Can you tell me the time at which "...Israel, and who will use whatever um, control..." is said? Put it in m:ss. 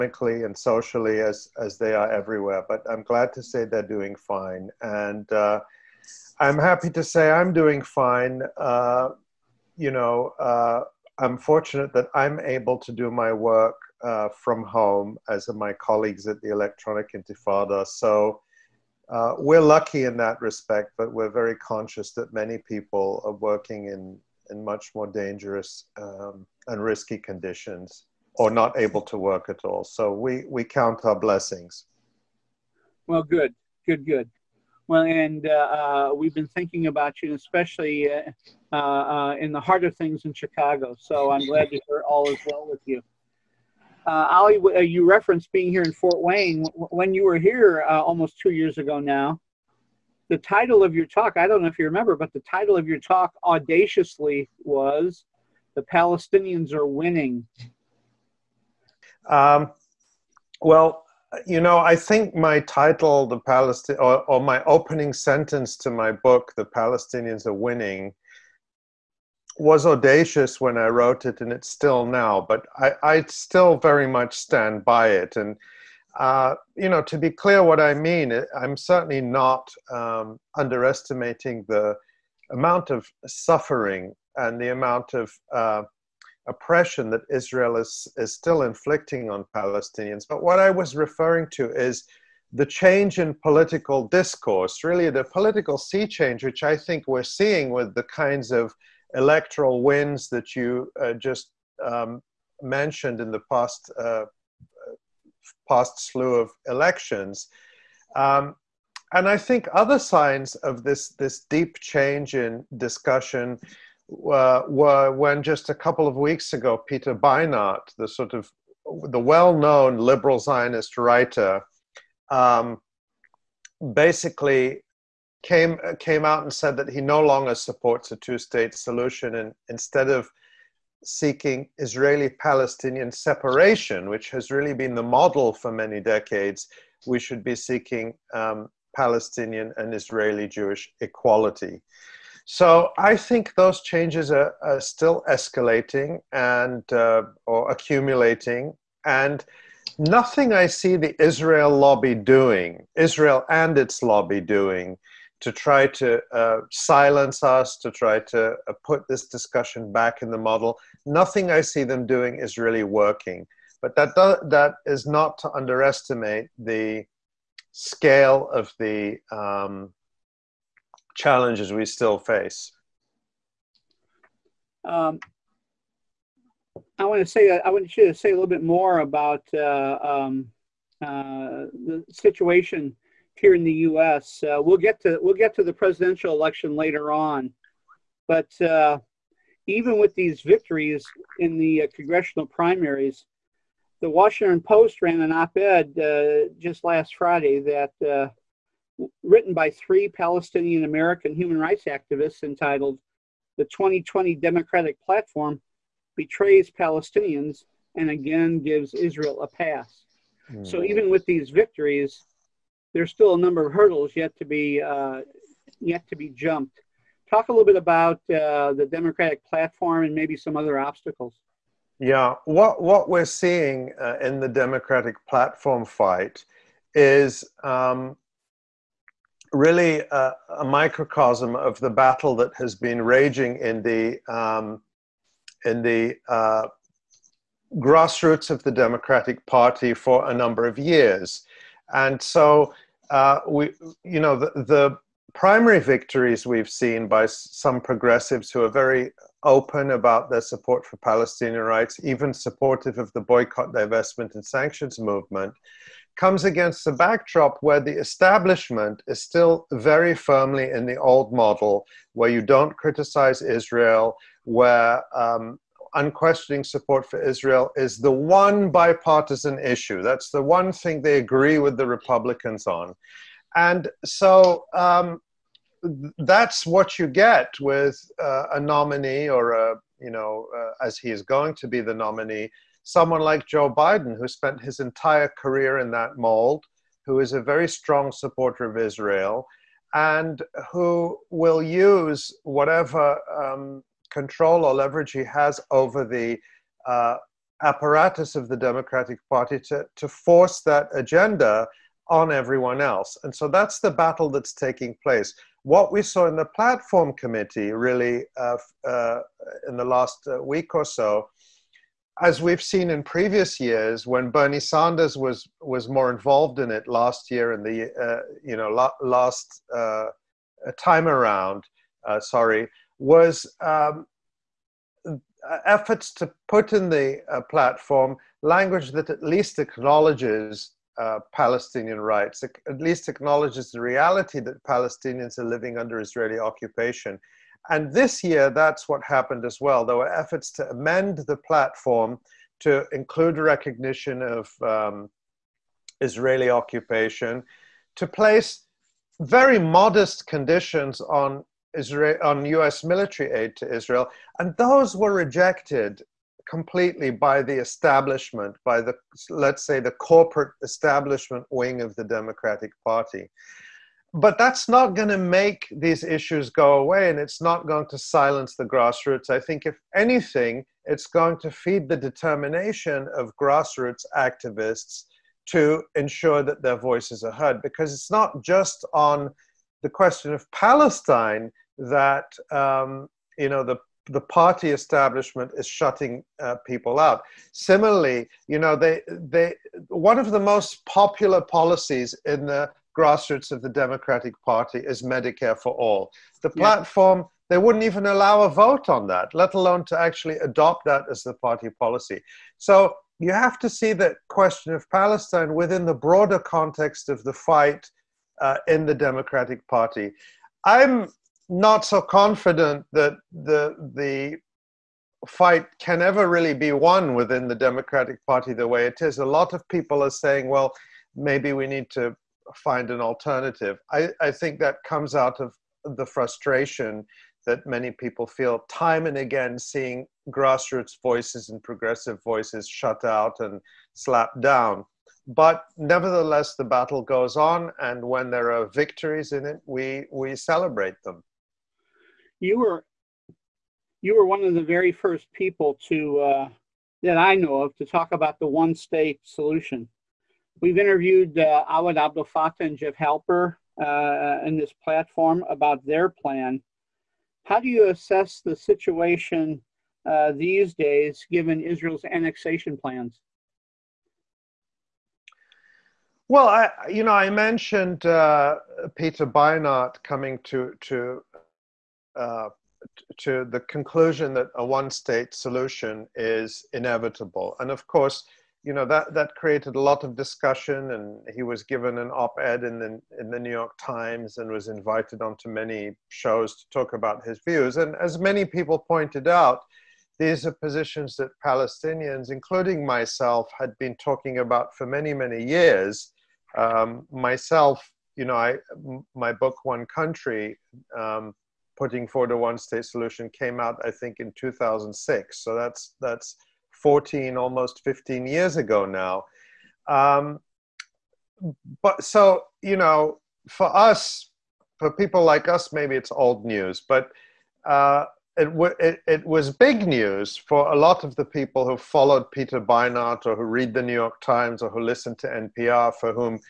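4:48.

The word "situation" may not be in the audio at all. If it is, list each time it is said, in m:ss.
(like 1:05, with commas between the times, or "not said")
3:02, 7:38.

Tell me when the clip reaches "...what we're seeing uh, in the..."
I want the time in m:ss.
3:42.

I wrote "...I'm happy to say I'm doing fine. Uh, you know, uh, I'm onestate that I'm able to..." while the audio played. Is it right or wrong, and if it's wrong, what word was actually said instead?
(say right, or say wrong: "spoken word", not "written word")
wrong: "fortunate", not "onestate".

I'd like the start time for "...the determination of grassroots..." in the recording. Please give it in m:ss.
6:11.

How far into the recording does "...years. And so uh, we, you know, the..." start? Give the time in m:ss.
4:00.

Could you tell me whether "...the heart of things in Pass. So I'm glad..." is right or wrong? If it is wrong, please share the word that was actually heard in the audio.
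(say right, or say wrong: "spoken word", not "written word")
wrong: "Chicago", not "Pass".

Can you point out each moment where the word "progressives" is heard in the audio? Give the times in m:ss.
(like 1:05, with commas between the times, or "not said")
4:07, 7:11.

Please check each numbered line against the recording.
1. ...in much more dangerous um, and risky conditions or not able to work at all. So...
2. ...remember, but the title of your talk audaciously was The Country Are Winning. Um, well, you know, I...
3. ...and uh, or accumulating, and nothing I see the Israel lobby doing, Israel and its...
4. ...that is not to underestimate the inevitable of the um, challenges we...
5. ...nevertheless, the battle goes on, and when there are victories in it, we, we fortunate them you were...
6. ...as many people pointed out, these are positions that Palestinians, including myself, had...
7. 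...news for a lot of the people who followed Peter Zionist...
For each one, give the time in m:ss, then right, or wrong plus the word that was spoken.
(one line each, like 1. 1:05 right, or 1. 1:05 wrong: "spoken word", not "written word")
1. 0:24 right
2. 0:51 wrong: "Palestinians", not "Country"
3. 2:26 right
4. 2:44 wrong: "scale", not "inevitable"
5. 7:15 wrong: "celebrate", not "fortunate"
6. 8:07 right
7. 8:39 wrong: "Beinart", not "Zionist".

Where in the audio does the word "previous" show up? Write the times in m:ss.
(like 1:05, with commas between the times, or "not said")
5:13.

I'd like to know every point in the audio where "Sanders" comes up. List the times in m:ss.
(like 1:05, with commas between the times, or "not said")
5:14.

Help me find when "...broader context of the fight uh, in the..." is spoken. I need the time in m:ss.
6:45.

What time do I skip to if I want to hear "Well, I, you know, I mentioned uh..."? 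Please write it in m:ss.
7:46.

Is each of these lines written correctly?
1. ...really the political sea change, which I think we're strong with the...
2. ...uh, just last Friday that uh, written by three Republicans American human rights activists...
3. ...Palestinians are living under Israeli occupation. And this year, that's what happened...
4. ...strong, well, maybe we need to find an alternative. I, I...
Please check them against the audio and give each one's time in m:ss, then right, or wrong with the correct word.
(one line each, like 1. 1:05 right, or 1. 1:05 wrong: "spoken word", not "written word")
1. 1:34 wrong: "seeing", not "strong"
2. 3:15 wrong: "Palestinian", not "Republicans"
3. 5:34 right
4. 7:00 wrong: "saying", not "strong".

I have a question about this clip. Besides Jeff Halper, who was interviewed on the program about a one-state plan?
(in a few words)
Awad Abdel Fattah.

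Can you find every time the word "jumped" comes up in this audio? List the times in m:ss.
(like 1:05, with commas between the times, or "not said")
3:36.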